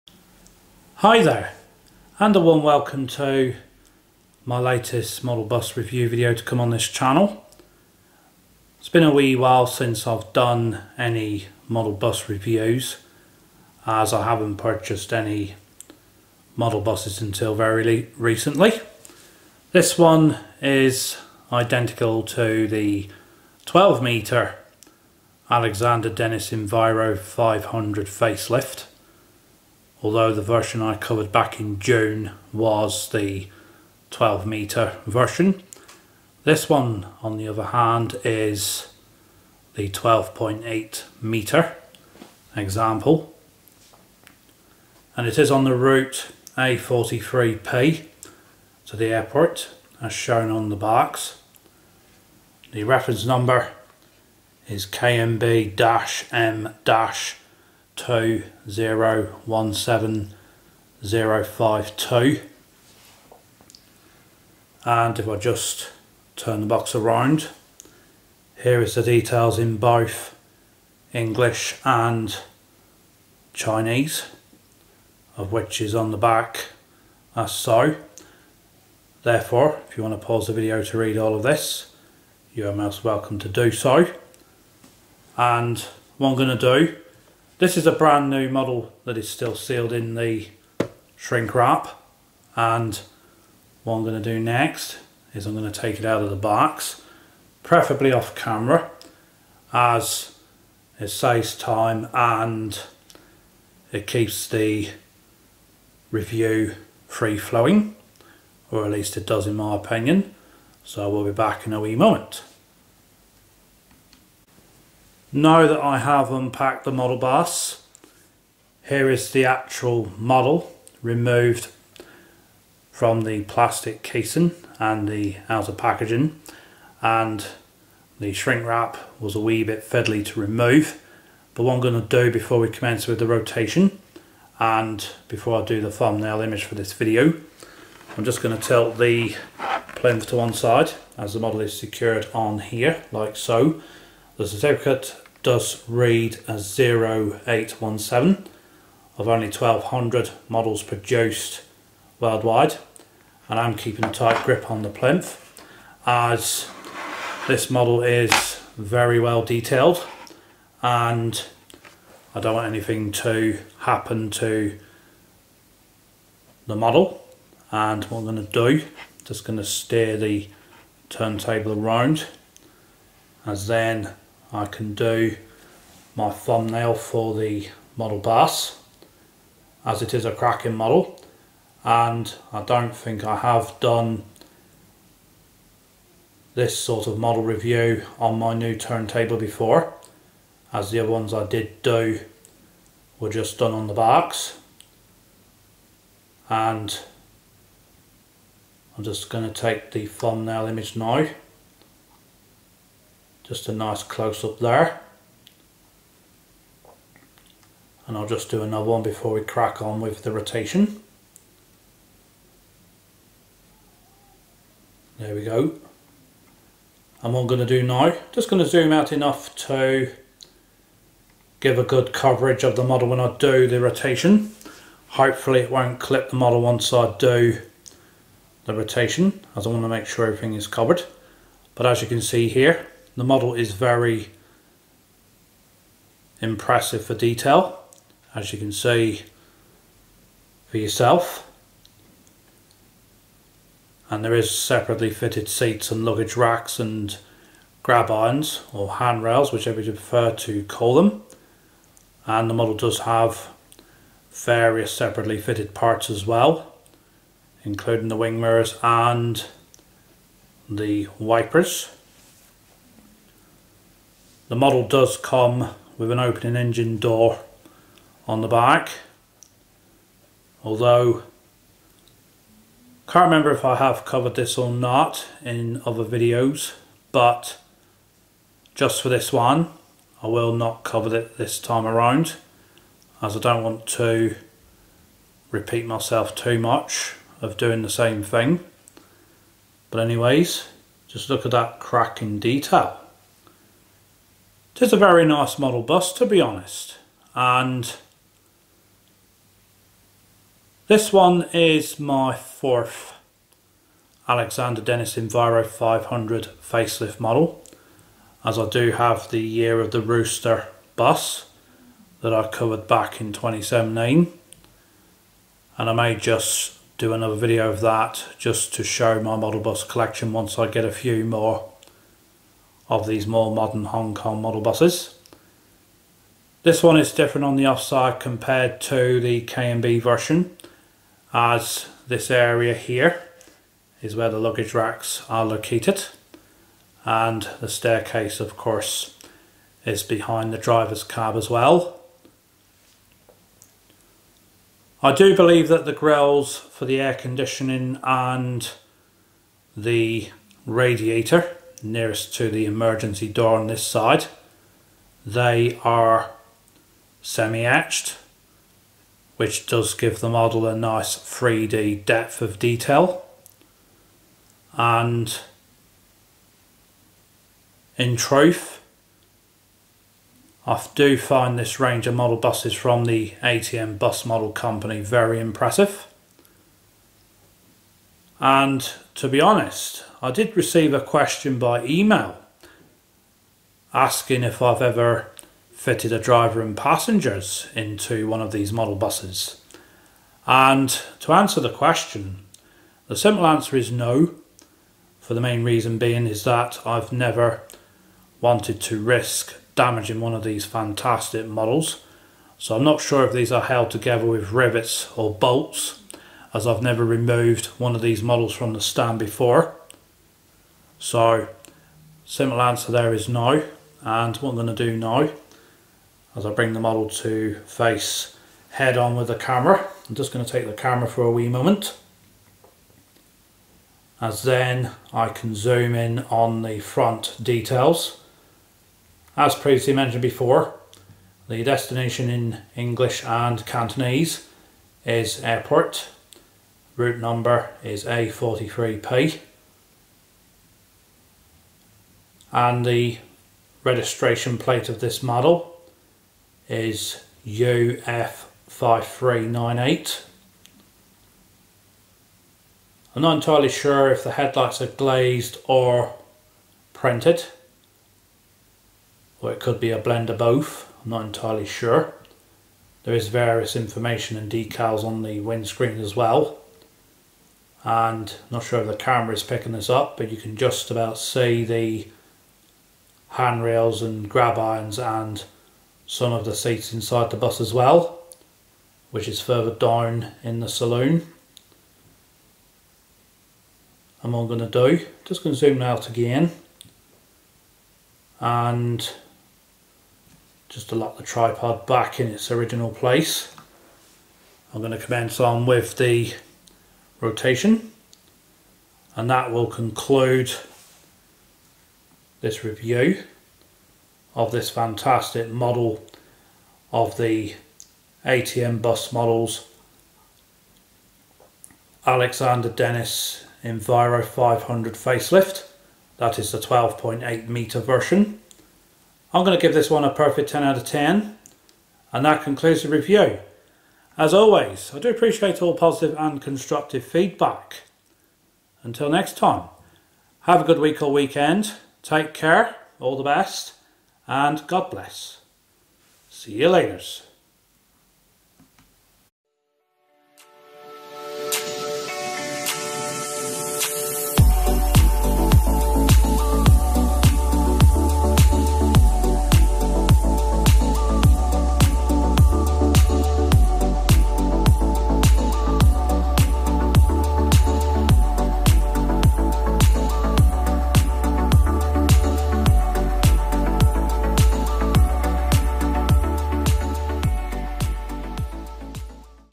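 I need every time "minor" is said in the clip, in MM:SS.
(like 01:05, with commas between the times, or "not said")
not said.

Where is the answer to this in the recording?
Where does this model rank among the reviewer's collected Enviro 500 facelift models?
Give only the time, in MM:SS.
05:02.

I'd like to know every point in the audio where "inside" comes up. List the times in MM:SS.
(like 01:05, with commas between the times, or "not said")
07:56.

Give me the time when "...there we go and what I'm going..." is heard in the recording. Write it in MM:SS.
03:35.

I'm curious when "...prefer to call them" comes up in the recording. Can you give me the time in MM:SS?
04:09.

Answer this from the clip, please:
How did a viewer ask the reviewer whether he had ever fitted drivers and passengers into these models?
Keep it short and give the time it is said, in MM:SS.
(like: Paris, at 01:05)
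email, at 06:21.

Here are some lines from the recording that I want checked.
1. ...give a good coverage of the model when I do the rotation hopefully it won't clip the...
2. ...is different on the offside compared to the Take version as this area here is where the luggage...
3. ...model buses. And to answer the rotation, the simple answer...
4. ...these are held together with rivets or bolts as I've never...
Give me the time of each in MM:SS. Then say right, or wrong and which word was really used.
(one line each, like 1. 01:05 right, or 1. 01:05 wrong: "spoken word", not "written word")
1. 03:41 right
2. 05:26 wrong: "KMB", not "Take"
3. 06:28 wrong: "question", not "rotation"
4. 06:43 right.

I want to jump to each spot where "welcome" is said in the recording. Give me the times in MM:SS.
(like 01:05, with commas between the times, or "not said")
00:02, 01:23.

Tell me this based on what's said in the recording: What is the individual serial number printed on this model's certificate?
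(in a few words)
0817.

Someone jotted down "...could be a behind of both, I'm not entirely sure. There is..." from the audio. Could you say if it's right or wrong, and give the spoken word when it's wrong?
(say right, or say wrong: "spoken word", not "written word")
wrong: "blend", not "behind".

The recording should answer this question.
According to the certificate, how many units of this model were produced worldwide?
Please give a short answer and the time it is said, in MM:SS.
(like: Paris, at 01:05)
1200, at 02:29.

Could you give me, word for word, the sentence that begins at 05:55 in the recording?
They are semi etched which does give the model a nice 3D depth of detail.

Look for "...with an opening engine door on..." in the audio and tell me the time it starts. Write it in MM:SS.
04:25.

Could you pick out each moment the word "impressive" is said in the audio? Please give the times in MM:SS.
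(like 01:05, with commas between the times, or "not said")
03:56, 06:15.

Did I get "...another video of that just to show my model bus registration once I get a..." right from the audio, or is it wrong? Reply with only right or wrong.
wrong.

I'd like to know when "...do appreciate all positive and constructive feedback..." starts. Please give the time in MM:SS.
08:44.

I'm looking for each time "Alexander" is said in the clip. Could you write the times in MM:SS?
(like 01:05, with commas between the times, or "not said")
00:25, 05:04, 08:32.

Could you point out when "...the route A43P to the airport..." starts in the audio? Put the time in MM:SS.
00:45.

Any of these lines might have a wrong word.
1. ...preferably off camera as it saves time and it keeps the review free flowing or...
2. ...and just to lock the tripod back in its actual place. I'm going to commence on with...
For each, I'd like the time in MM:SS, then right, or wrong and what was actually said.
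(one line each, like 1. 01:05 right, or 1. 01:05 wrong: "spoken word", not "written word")
1. 01:37 right
2. 08:08 wrong: "original", not "actual".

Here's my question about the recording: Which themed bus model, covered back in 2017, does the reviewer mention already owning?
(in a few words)
year of the rooster bus.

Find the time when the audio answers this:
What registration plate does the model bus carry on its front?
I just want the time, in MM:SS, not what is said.
07:27.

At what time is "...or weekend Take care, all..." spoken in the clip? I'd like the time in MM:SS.
08:51.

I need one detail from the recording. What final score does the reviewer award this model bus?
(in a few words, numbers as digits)
10 out of 10.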